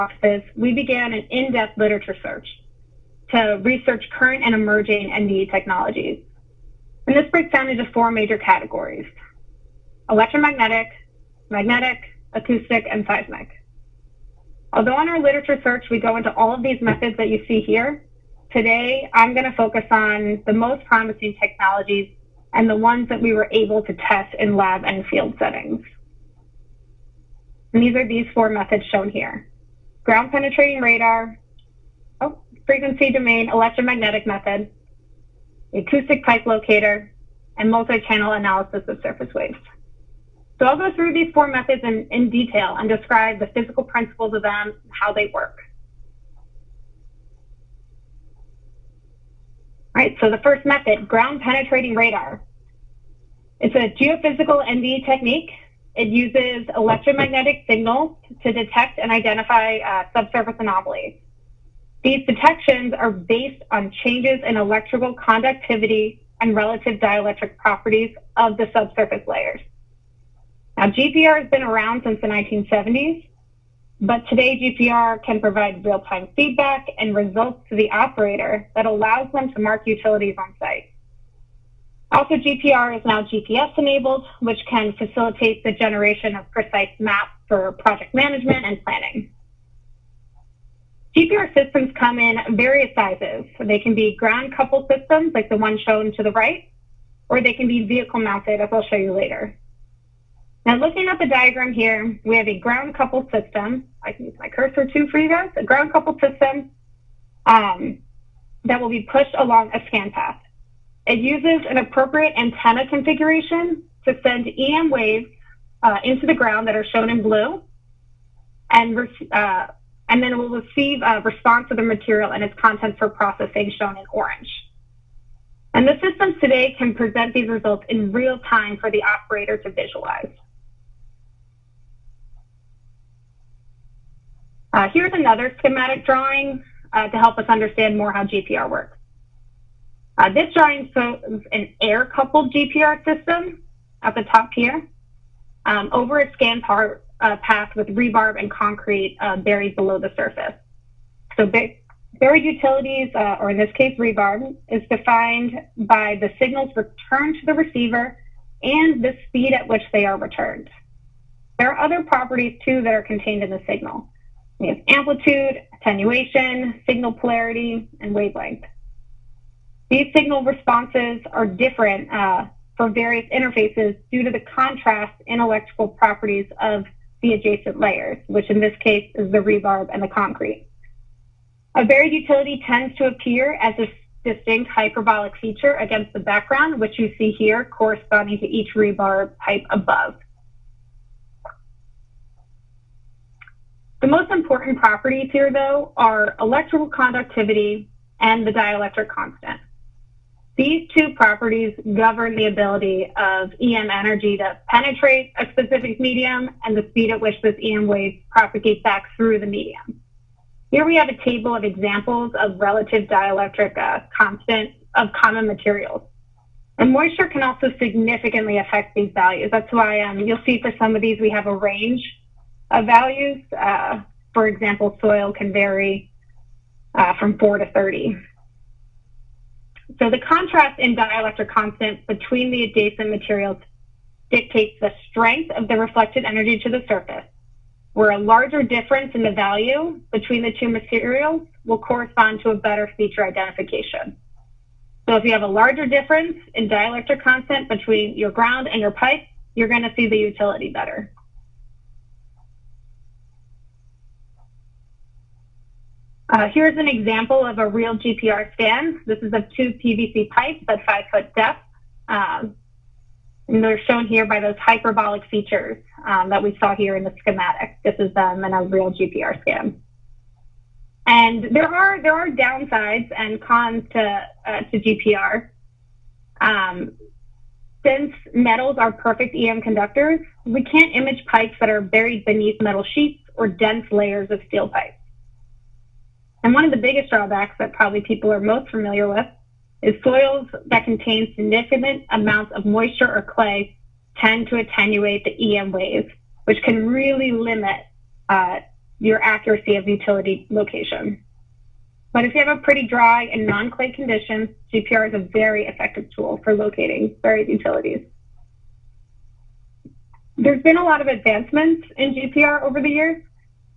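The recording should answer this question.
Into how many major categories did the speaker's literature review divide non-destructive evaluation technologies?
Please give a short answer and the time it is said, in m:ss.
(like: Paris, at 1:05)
4, at 0:07.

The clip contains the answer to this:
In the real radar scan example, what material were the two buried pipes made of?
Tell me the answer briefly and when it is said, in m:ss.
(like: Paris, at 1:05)
PVC, at 4:19.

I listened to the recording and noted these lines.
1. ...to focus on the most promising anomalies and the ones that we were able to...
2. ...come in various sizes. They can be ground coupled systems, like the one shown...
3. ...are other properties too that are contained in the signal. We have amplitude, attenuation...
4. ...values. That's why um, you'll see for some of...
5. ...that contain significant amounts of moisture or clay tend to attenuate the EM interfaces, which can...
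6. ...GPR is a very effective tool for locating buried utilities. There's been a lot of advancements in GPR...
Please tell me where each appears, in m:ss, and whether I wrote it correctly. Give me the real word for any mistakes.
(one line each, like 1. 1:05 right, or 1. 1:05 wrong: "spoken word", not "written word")
1. 0:19 wrong: "technologies", not "anomalies"
2. 1:31 right
3. 2:41 right
4. 3:39 right
5. 4:50 wrong: "waves", not "interfaces"
6. 5:04 right.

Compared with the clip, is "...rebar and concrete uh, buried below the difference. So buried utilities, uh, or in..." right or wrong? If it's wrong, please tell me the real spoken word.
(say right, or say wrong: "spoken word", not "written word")
wrong: "surface", not "difference".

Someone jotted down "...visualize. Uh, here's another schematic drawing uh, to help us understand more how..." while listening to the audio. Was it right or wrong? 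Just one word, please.
right.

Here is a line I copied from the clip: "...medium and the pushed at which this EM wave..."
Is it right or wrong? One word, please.
wrong.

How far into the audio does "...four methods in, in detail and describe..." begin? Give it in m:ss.
0:41.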